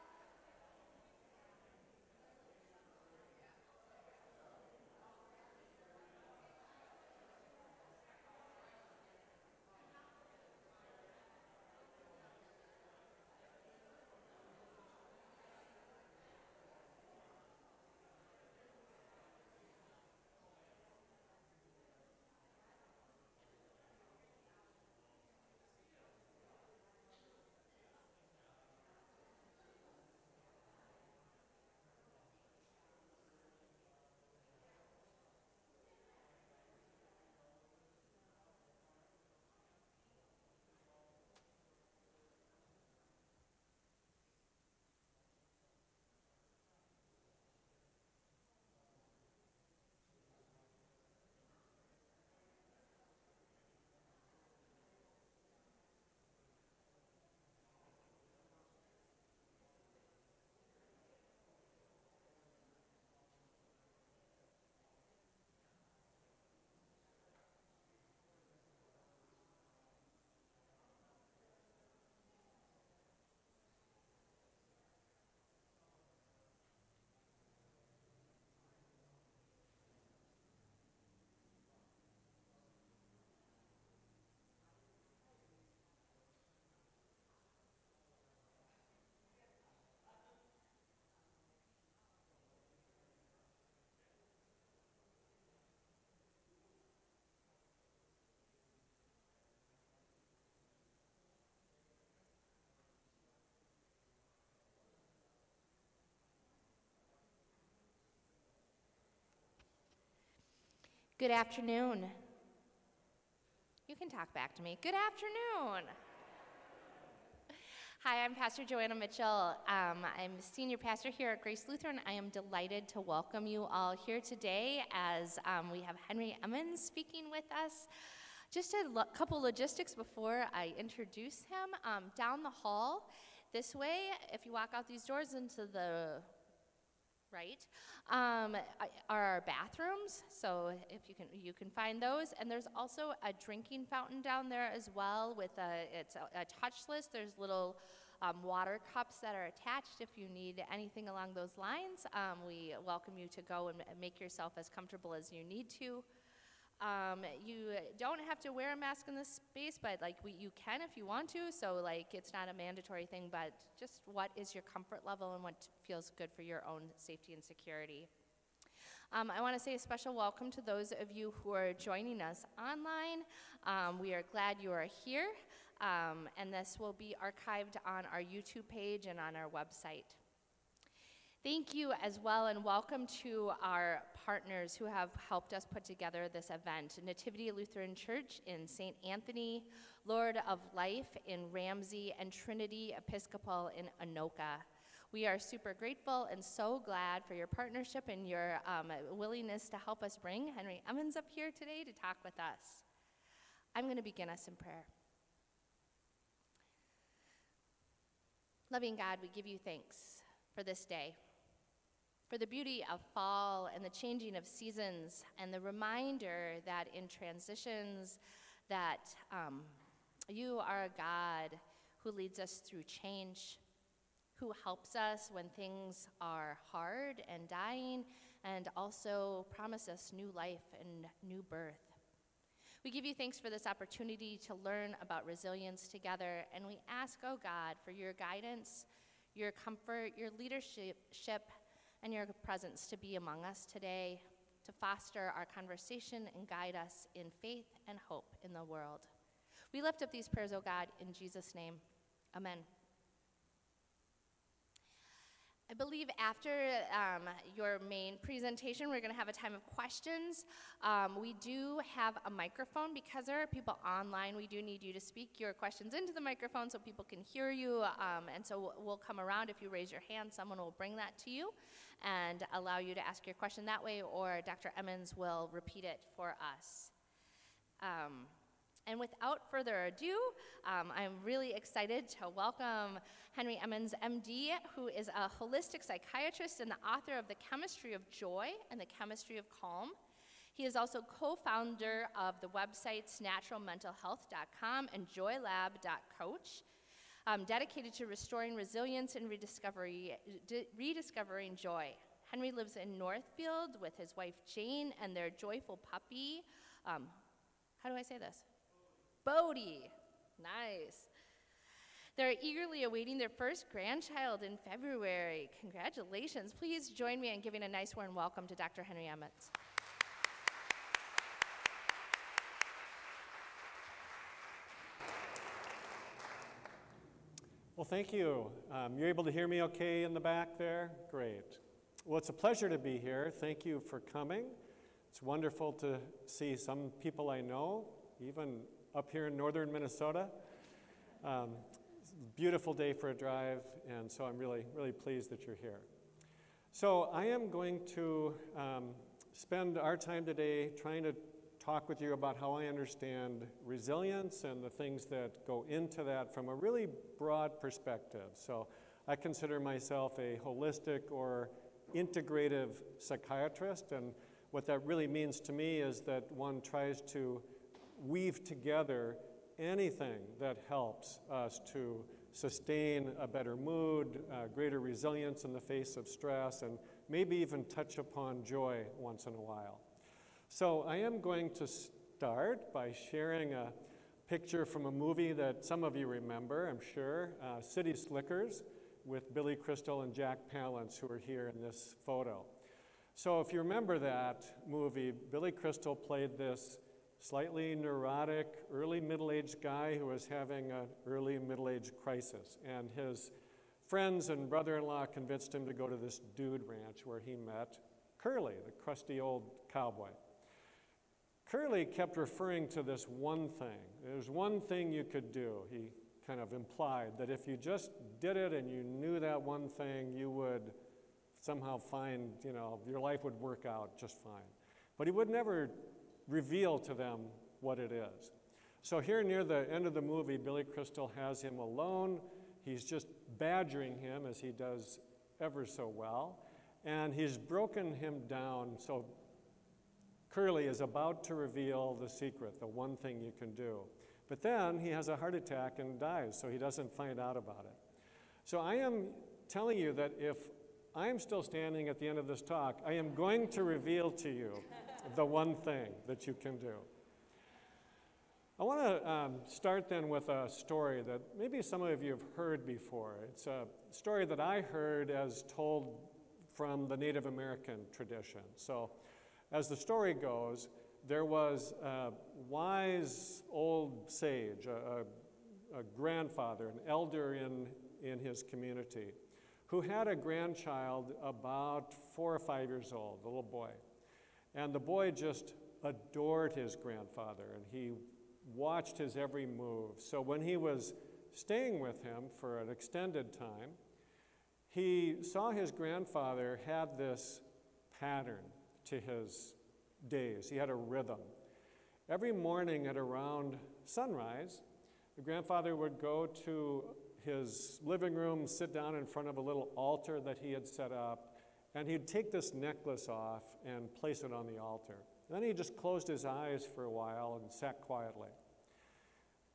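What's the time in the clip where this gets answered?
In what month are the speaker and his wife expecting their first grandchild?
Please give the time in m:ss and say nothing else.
5:14.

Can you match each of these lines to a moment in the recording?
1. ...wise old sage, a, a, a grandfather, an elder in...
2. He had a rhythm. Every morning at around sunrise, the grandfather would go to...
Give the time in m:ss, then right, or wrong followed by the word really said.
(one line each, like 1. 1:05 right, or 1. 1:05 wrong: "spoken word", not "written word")
1. 7:52 right
2. 8:20 right.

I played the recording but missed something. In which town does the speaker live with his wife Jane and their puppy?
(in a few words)
Northfield.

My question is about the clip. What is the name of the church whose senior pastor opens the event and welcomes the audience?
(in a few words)
Grace Lutheran.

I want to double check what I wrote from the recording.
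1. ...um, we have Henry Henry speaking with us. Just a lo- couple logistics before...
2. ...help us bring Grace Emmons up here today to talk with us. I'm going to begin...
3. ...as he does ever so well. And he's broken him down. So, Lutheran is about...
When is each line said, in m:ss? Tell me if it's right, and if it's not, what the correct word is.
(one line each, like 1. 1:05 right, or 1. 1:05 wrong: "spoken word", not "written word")
1. 2:05 wrong: "Emmons", not "Henry"
2. 3:19 wrong: "Henry", not "Grace"
3. 7:14 wrong: "Curly", not "Lutheran".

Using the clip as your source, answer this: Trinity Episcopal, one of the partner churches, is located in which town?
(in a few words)
Anoka.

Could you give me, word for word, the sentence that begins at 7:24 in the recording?
But then he has a heart attack and dies, so he doesn't find out about it.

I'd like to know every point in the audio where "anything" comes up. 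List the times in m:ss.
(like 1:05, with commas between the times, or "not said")
2:30, 6:09.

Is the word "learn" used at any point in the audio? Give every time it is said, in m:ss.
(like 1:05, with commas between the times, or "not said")
3:54.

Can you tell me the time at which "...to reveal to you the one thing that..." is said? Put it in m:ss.
7:33.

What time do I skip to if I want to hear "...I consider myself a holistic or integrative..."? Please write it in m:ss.
5:59.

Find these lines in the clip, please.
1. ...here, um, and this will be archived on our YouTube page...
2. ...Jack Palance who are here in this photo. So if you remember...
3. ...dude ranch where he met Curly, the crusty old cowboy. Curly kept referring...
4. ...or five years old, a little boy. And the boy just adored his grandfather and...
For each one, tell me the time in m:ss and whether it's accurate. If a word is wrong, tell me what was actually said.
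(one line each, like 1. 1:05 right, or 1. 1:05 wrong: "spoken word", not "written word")
1. 2:55 right
2. 6:30 right
3. 6:46 right
4. 8:02 right.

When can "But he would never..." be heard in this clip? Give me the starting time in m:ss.
7:04.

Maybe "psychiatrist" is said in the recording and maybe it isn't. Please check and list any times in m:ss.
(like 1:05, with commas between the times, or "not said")
4:45, 6:02.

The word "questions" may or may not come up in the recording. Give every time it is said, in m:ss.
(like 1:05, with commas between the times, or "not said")
4:19, 4:25, 4:33.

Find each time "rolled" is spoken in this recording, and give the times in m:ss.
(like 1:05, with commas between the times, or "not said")
not said.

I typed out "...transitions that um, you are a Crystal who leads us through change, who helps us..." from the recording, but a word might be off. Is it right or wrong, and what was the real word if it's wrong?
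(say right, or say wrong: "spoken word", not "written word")
wrong: "God", not "Crystal".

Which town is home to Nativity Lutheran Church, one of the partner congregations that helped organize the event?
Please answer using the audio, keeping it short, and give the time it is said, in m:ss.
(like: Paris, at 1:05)
St. Anthony, at 3:08.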